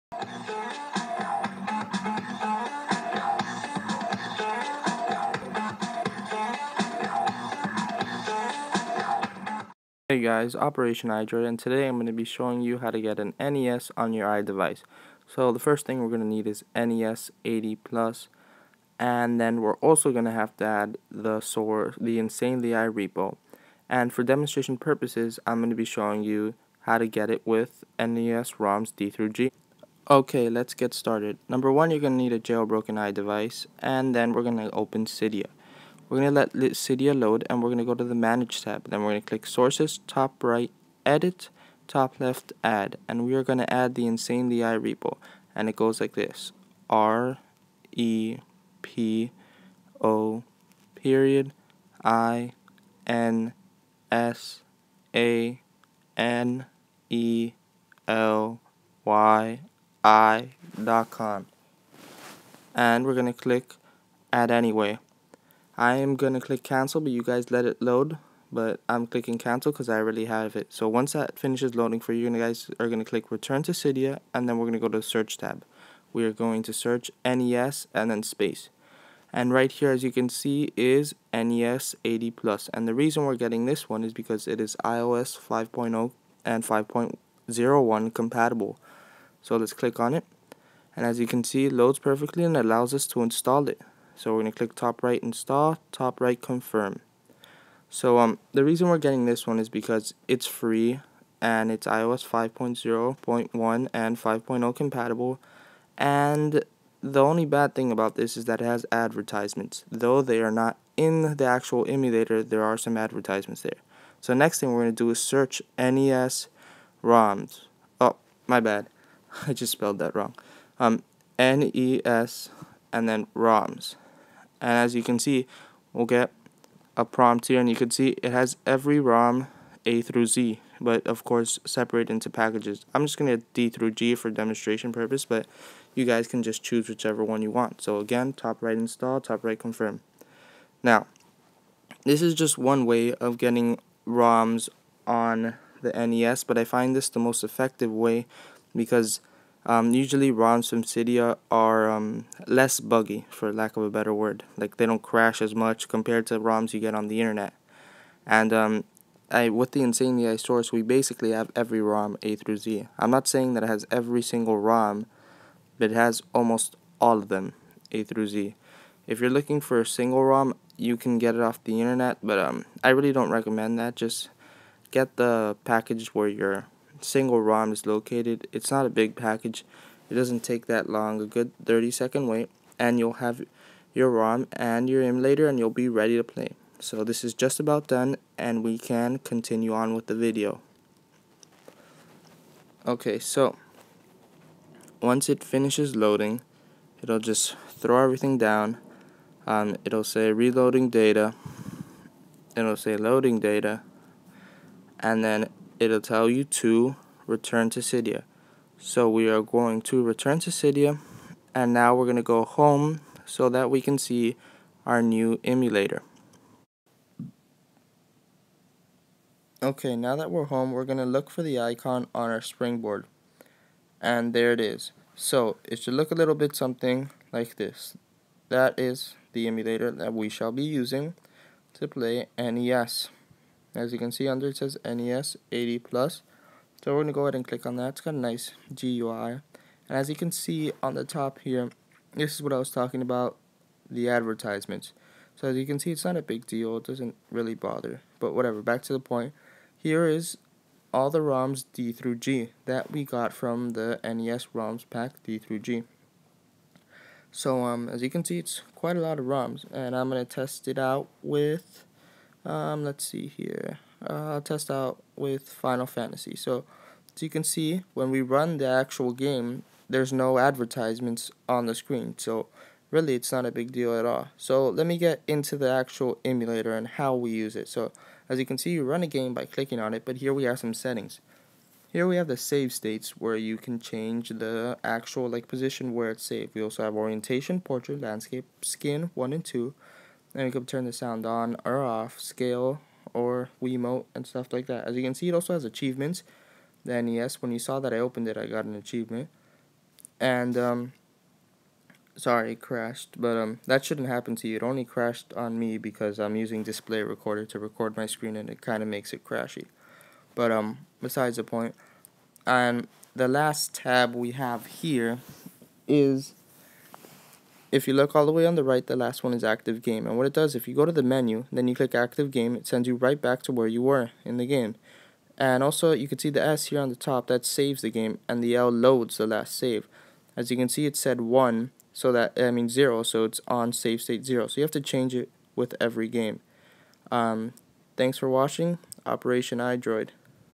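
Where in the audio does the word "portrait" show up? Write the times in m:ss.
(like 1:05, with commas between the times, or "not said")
4:47.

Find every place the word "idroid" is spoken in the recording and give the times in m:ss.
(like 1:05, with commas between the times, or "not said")
0:11, 5:39.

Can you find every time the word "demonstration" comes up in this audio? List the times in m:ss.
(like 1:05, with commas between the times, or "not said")
0:24, 2:14.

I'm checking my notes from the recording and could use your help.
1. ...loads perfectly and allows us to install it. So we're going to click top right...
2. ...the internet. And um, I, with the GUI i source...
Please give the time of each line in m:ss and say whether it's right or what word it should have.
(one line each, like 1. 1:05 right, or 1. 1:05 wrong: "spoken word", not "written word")
1. 1:31 right
2. 2:37 wrong: "Insanely", not "GUI".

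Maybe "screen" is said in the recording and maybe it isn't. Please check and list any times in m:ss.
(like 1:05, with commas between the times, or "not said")
4:31, 5:08.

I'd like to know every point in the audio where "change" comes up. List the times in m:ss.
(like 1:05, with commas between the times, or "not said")
4:43, 5:34.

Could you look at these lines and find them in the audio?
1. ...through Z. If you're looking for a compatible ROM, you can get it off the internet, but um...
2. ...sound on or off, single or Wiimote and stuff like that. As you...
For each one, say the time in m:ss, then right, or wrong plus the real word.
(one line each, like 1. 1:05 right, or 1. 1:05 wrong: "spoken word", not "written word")
1. 2:48 wrong: "single", not "compatible"
2. 4:50 wrong: "scale", not "single".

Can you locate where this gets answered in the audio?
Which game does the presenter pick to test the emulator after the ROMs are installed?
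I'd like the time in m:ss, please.
4:25.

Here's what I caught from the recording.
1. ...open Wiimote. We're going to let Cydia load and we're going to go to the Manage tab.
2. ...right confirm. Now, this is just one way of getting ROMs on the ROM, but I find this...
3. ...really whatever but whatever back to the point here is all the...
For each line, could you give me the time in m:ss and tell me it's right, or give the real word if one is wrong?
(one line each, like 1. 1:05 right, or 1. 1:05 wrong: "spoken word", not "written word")
1. 0:34 wrong: "Cydia", not "Wiimote"
2. 2:19 wrong: "NES", not "ROM"
3. 4:07 wrong: "bother", not "whatever".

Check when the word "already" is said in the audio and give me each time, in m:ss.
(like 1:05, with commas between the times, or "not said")
1:09.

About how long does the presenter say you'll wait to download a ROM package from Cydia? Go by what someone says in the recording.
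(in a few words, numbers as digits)
30 seconds.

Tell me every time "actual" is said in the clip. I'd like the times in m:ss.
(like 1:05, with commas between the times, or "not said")
1:51, 4:28, 4:35, 4:44.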